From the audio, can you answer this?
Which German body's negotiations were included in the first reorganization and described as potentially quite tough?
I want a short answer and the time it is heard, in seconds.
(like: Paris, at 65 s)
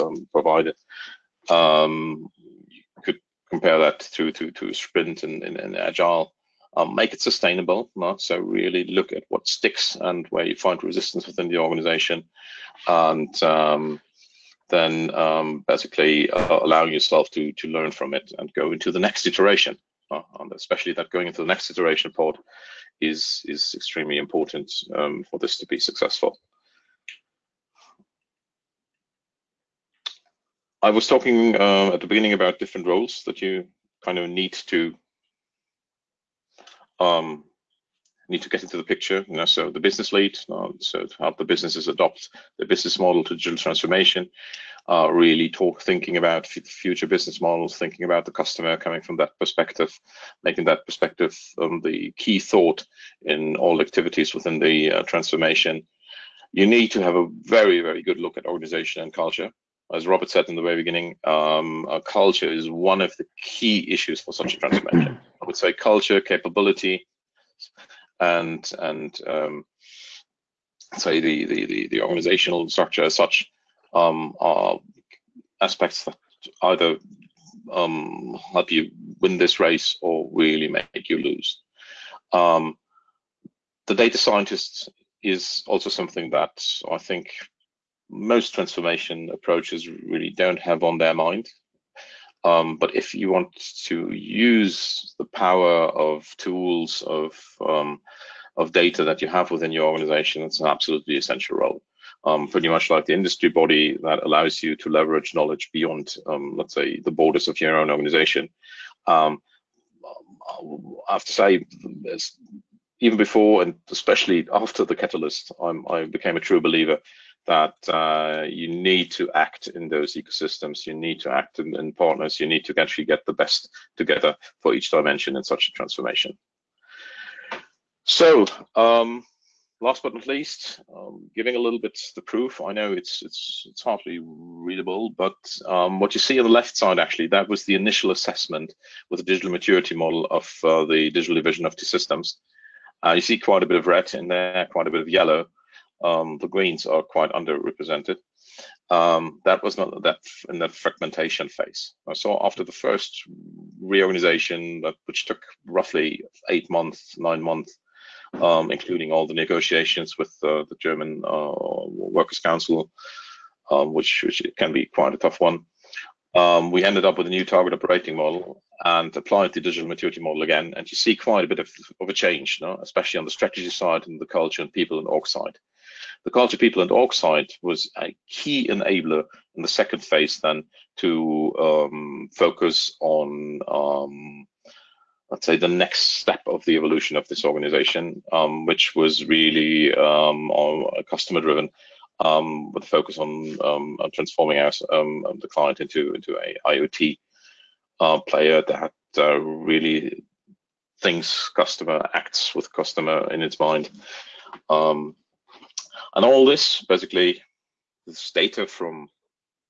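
Workers' Council, at 161 s.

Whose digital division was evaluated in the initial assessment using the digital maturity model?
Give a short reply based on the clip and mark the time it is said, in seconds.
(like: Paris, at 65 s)
T-Systems, at 141 s.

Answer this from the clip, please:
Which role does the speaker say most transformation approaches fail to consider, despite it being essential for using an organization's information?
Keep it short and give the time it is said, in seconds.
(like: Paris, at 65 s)
Data scientist, at 83 s.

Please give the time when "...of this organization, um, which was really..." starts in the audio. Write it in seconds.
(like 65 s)
187 s.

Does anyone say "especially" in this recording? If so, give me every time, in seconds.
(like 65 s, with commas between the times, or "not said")
20 s, 113 s, 172 s.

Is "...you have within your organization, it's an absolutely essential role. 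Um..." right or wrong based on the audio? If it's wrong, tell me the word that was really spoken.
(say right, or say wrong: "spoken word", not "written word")
right.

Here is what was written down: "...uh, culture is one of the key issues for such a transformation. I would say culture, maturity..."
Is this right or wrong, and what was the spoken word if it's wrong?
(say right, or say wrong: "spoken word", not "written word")
wrong: "capability", not "maturity".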